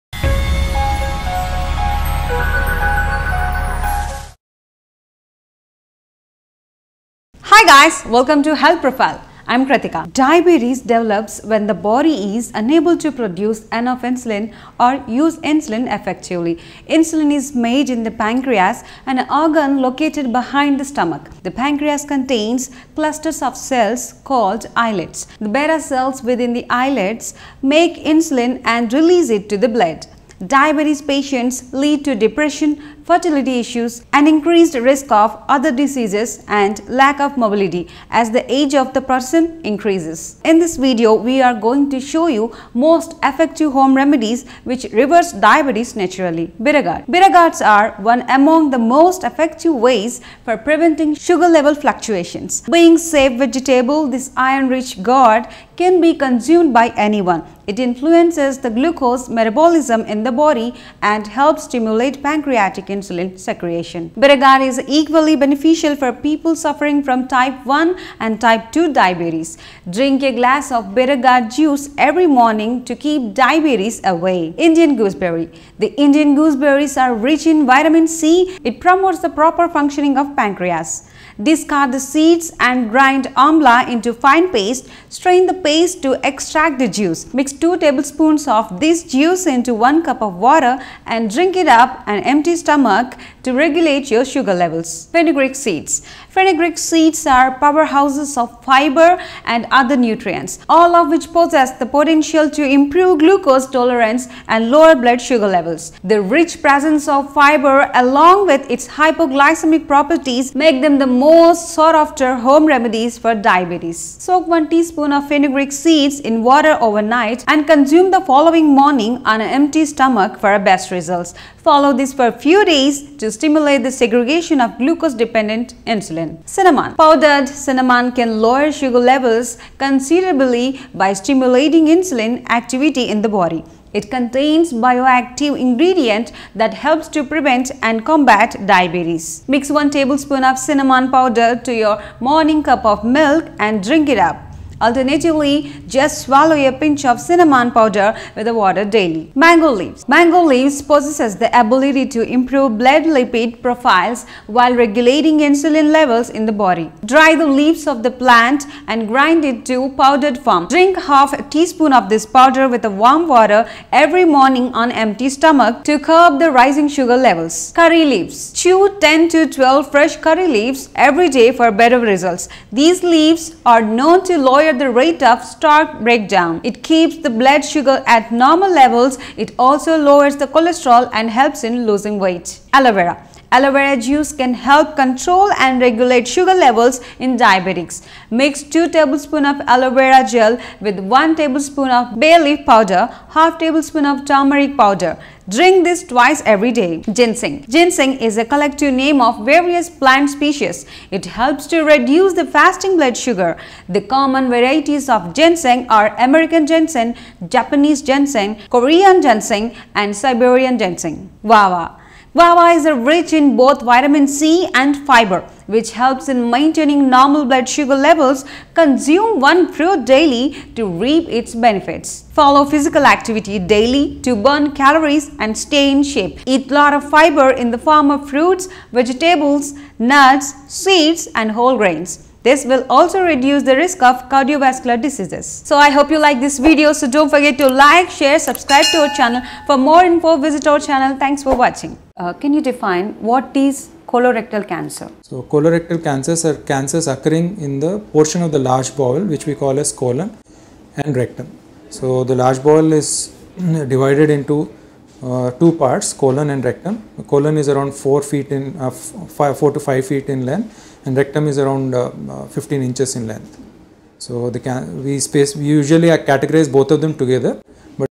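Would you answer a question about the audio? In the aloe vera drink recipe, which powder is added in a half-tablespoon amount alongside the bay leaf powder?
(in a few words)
turmeric powder.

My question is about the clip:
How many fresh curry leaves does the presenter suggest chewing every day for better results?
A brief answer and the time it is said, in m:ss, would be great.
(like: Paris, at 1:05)
10 to 12, at 2:48.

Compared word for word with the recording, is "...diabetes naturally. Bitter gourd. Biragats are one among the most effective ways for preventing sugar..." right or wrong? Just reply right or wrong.
right.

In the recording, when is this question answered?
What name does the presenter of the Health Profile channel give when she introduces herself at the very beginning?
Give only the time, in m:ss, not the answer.
0:09.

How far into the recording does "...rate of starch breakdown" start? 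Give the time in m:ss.
2:54.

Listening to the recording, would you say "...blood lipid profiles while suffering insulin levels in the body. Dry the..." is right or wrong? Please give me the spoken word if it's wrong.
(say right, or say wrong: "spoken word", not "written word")
wrong: "regulating", not "suffering".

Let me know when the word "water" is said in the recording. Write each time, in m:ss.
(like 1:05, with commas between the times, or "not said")
1:30, 1:56, 2:28, 2:43.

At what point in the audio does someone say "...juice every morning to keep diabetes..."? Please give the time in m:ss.
1:11.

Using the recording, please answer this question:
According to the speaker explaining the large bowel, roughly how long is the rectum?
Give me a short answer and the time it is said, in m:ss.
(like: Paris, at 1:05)
15 inches, at 4:22.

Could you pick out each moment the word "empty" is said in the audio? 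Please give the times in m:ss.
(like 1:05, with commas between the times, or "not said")
1:32, 1:59, 2:44.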